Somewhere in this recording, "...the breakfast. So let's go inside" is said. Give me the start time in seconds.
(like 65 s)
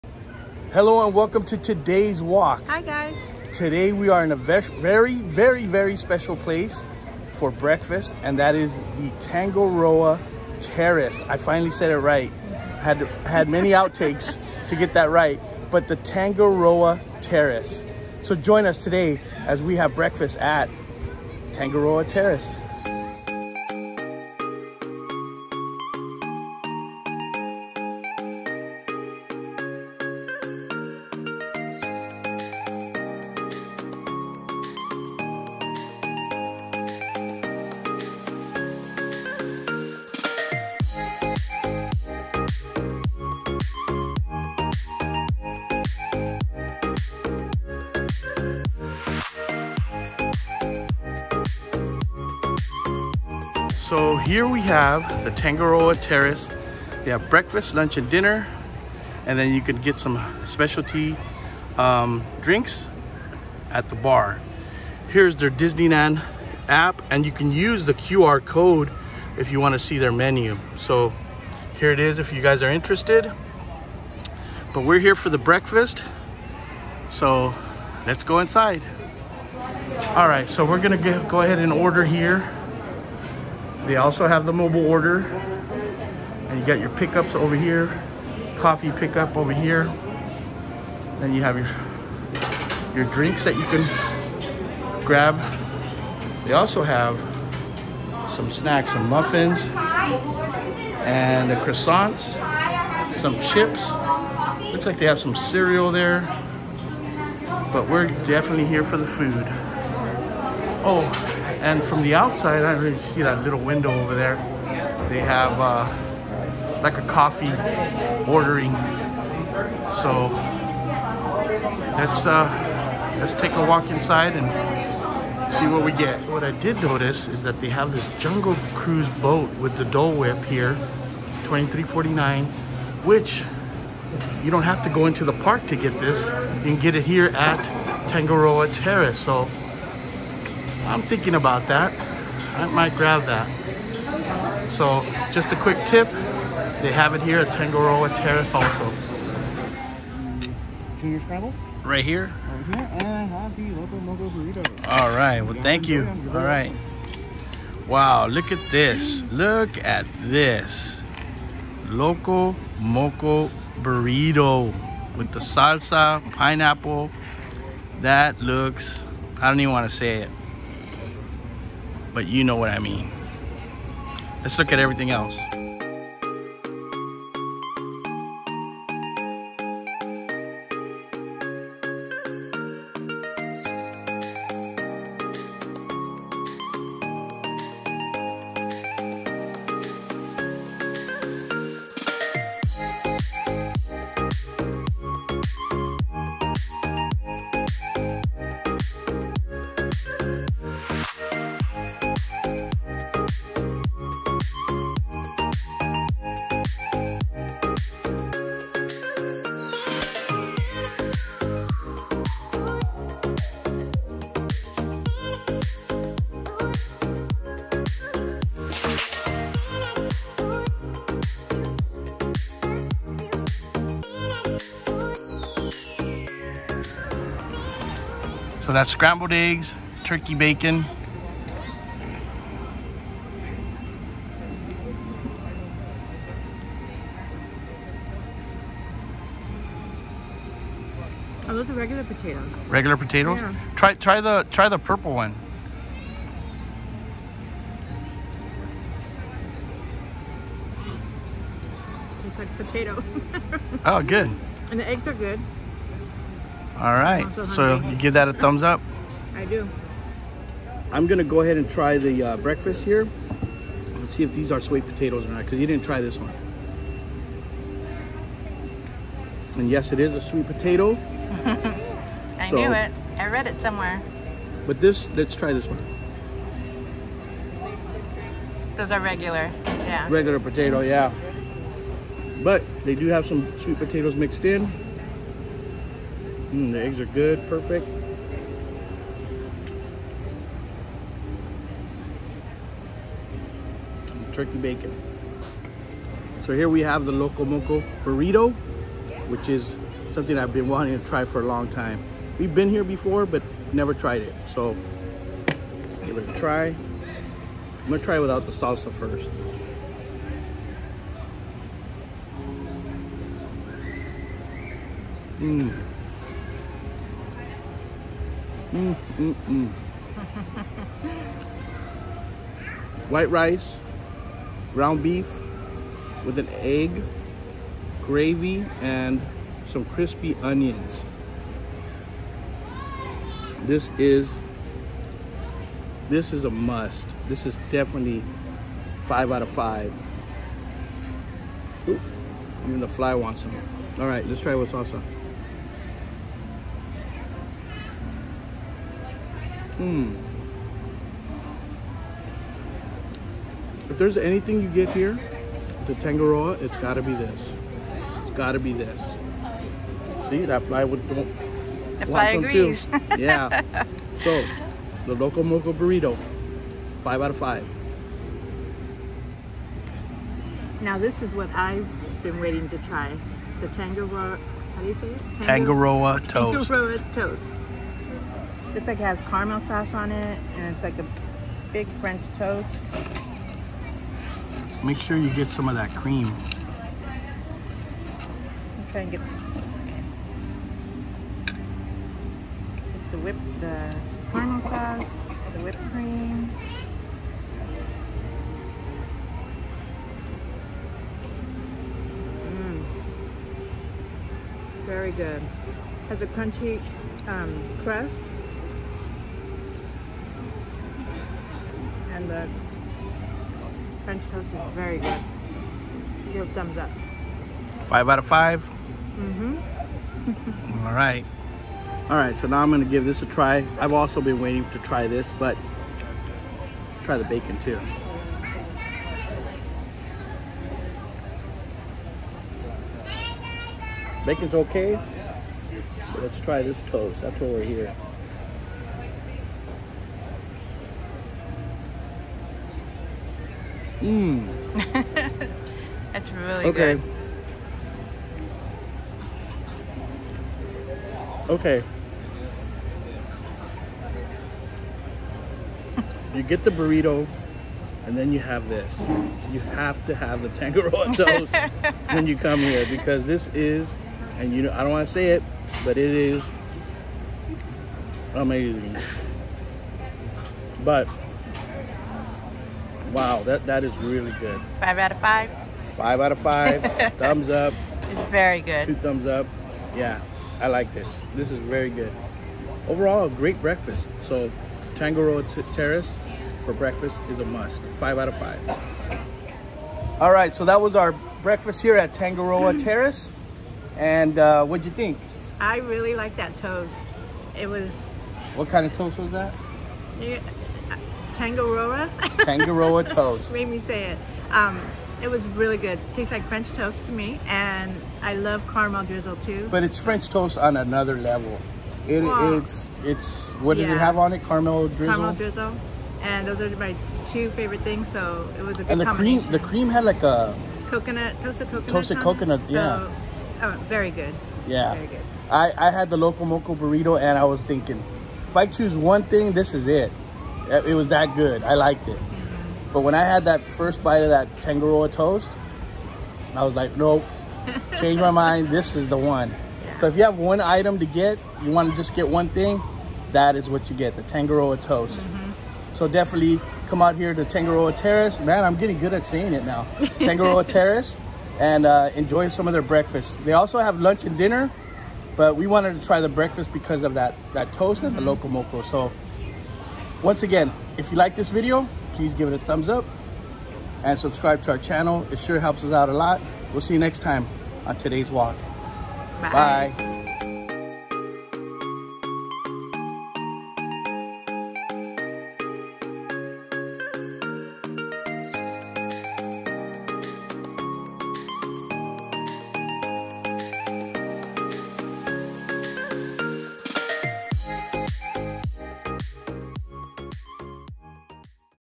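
75 s.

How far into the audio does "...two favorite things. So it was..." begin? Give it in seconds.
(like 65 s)
517 s.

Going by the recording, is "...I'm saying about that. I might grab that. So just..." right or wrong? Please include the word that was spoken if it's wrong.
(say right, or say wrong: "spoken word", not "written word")
wrong: "thinking", not "saying".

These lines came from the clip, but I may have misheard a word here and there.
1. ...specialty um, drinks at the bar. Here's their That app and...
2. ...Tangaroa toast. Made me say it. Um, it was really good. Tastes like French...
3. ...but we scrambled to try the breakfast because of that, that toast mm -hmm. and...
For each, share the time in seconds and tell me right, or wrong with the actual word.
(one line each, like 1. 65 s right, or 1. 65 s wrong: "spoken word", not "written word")
1. 60 s wrong: "Disneyland", not "That"
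2. 502 s right
3. 555 s wrong: "wanted", not "scrambled".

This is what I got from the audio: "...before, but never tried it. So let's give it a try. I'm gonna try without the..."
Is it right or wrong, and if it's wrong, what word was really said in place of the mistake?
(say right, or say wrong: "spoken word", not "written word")
right.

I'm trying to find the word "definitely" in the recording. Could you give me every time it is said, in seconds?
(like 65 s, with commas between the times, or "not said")
108 s, 337 s, 546 s.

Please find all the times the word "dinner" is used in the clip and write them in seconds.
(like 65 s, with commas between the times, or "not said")
58 s, 554 s.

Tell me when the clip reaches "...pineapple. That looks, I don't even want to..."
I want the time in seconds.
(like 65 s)
166 s.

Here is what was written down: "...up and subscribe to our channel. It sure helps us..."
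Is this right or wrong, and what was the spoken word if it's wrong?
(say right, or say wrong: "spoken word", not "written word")
right.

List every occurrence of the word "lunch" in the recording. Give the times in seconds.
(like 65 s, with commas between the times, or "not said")
57 s, 553 s.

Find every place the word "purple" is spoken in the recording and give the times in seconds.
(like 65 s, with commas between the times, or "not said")
244 s.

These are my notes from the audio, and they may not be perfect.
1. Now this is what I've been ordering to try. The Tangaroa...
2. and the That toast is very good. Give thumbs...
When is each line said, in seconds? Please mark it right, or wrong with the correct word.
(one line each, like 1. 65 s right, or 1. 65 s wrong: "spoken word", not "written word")
1. 370 s wrong: "waiting", not "ordering"
2. 412 s wrong: "French", not "That".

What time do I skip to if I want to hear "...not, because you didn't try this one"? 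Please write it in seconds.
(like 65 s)
265 s.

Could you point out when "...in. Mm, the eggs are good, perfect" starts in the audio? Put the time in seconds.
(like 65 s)
284 s.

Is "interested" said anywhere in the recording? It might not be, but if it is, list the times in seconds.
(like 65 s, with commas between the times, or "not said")
72 s.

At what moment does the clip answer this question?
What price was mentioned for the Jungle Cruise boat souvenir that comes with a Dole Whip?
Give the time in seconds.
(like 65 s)
131 s.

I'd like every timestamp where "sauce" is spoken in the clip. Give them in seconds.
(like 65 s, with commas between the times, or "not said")
379 s, 394 s.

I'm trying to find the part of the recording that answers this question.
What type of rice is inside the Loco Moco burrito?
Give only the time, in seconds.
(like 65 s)
323 s.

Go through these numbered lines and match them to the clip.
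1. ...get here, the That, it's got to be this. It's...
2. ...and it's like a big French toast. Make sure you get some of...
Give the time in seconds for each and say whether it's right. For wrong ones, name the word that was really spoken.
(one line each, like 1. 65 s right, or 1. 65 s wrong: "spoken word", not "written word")
1. 354 s wrong: "Tangaroa", not "That"
2. 380 s right.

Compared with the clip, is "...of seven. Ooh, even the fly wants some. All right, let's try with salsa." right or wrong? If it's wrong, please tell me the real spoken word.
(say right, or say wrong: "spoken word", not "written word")
wrong: "five", not "seven".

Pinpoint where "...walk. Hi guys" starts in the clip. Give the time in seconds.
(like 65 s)
2 s.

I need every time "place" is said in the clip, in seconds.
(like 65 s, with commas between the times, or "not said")
6 s.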